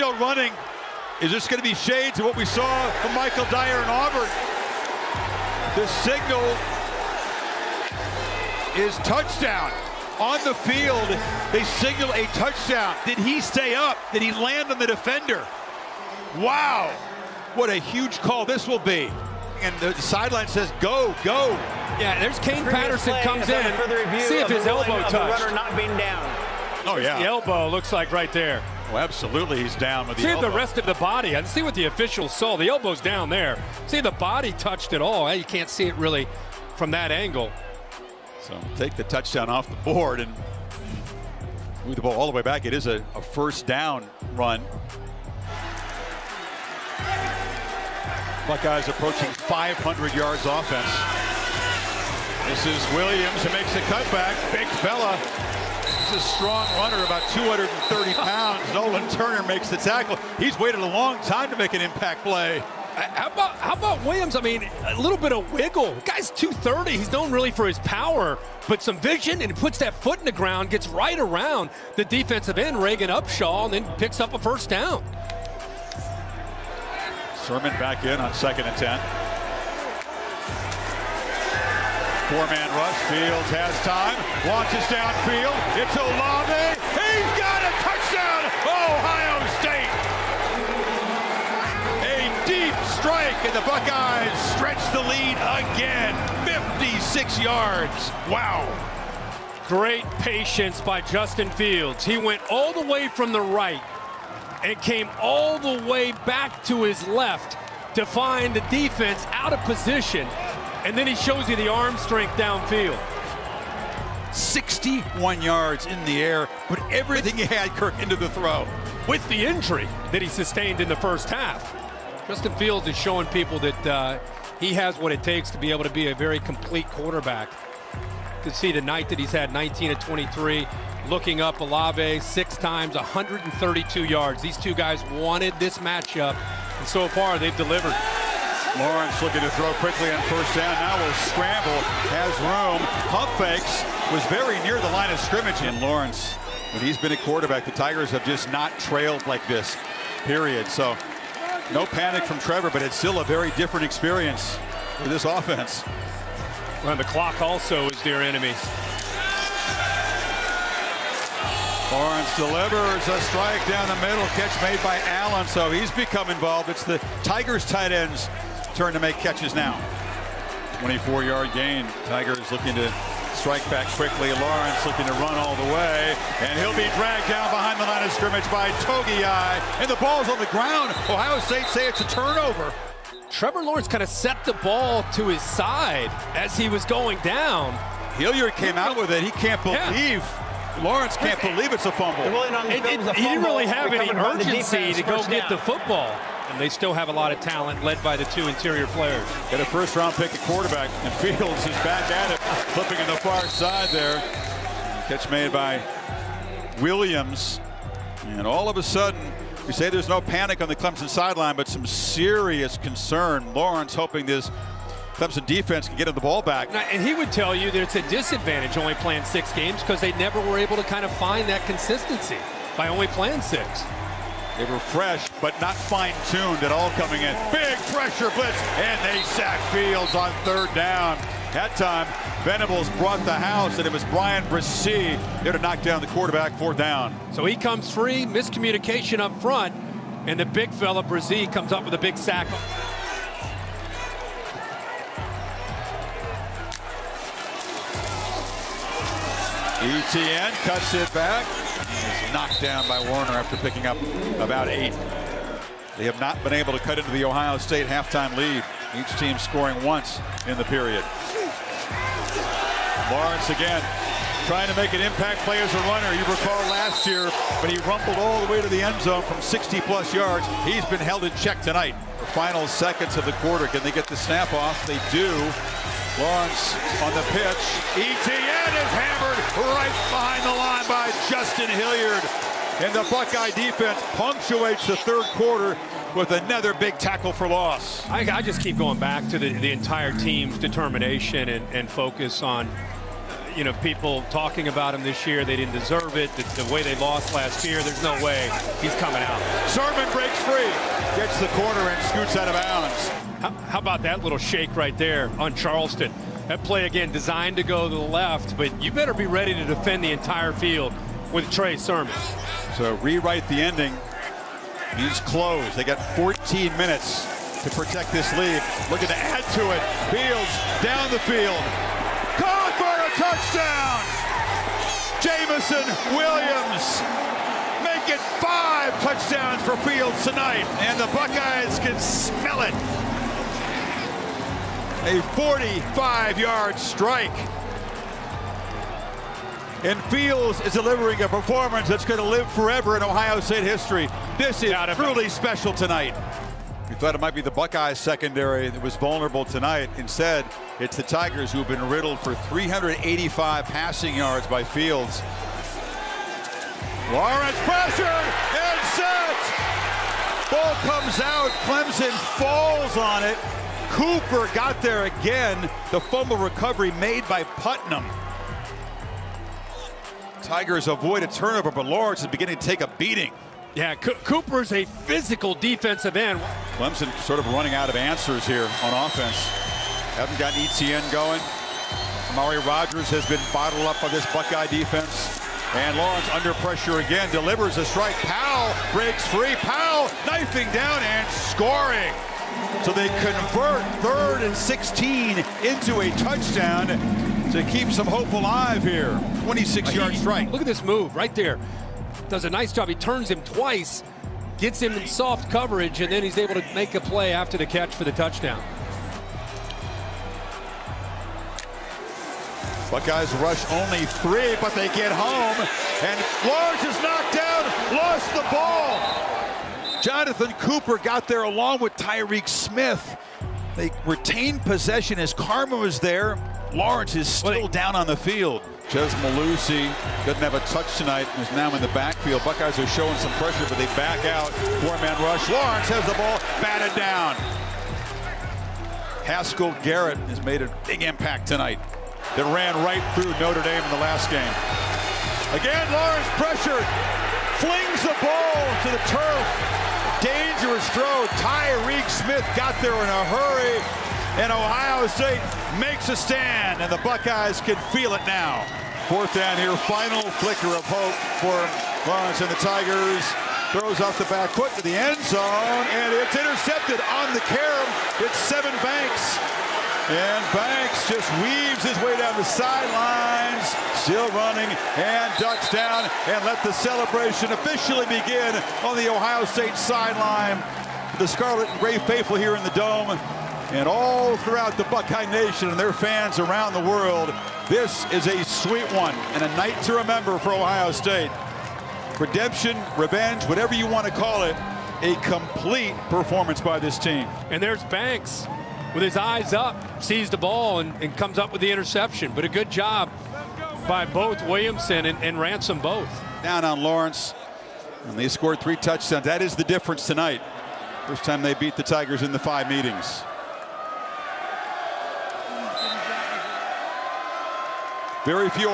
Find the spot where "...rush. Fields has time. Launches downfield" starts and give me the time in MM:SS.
01:22.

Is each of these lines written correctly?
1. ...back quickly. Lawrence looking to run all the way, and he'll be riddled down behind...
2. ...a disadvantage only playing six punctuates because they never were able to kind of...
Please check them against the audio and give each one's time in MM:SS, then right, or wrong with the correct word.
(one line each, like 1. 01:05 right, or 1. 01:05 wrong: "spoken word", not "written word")
1. 02:53 wrong: "dragged", not "riddled"
2. 03:37 wrong: "games", not "punctuates".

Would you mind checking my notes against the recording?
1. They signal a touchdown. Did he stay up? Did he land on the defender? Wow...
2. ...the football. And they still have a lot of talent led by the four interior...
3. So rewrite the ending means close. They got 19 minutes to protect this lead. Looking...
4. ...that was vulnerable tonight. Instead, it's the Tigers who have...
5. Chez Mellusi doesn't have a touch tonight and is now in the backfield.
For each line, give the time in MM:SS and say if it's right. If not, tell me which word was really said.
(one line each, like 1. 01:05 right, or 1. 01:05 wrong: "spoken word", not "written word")
1. 00:11 right
2. 03:15 wrong: "two", not "four"
3. 05:12 wrong: "14", not "19"
4. 05:48 right
5. 07:08 right.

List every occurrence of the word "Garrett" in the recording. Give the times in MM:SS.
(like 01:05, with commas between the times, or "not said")
07:19.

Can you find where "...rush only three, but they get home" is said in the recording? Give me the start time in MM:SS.
06:53.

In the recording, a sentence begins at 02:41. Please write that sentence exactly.
Lawrence delivers a strike down the middle, catch made by Allen, so he's become involved.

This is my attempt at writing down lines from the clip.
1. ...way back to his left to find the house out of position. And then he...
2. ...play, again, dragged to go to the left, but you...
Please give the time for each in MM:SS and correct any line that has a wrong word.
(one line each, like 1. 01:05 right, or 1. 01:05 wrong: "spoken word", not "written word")
1. 01:45 wrong: "defense", not "house"
2. 05:06 wrong: "designed", not "dragged".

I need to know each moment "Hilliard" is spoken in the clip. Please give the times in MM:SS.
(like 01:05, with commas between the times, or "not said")
03:08, 04:41.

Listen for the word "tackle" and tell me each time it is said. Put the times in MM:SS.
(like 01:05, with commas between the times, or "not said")
00:59, 04:46.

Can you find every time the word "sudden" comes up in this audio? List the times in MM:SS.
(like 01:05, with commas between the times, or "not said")
03:28.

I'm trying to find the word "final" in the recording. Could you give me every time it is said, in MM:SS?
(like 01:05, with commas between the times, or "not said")
04:32, 07:39.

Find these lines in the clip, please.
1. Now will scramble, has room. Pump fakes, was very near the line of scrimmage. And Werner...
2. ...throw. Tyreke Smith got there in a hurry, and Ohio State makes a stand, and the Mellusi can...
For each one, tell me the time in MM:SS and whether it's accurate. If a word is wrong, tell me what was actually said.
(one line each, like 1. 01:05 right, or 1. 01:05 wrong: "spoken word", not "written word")
1. 02:20 wrong: "Lawrence", not "Werner"
2. 07:30 wrong: "Buckeyes", not "Mellusi".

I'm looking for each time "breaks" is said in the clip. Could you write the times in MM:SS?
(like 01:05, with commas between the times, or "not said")
05:00, 06:28.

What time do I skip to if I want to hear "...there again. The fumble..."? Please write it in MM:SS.
06:04.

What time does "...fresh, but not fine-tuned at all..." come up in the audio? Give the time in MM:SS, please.
03:44.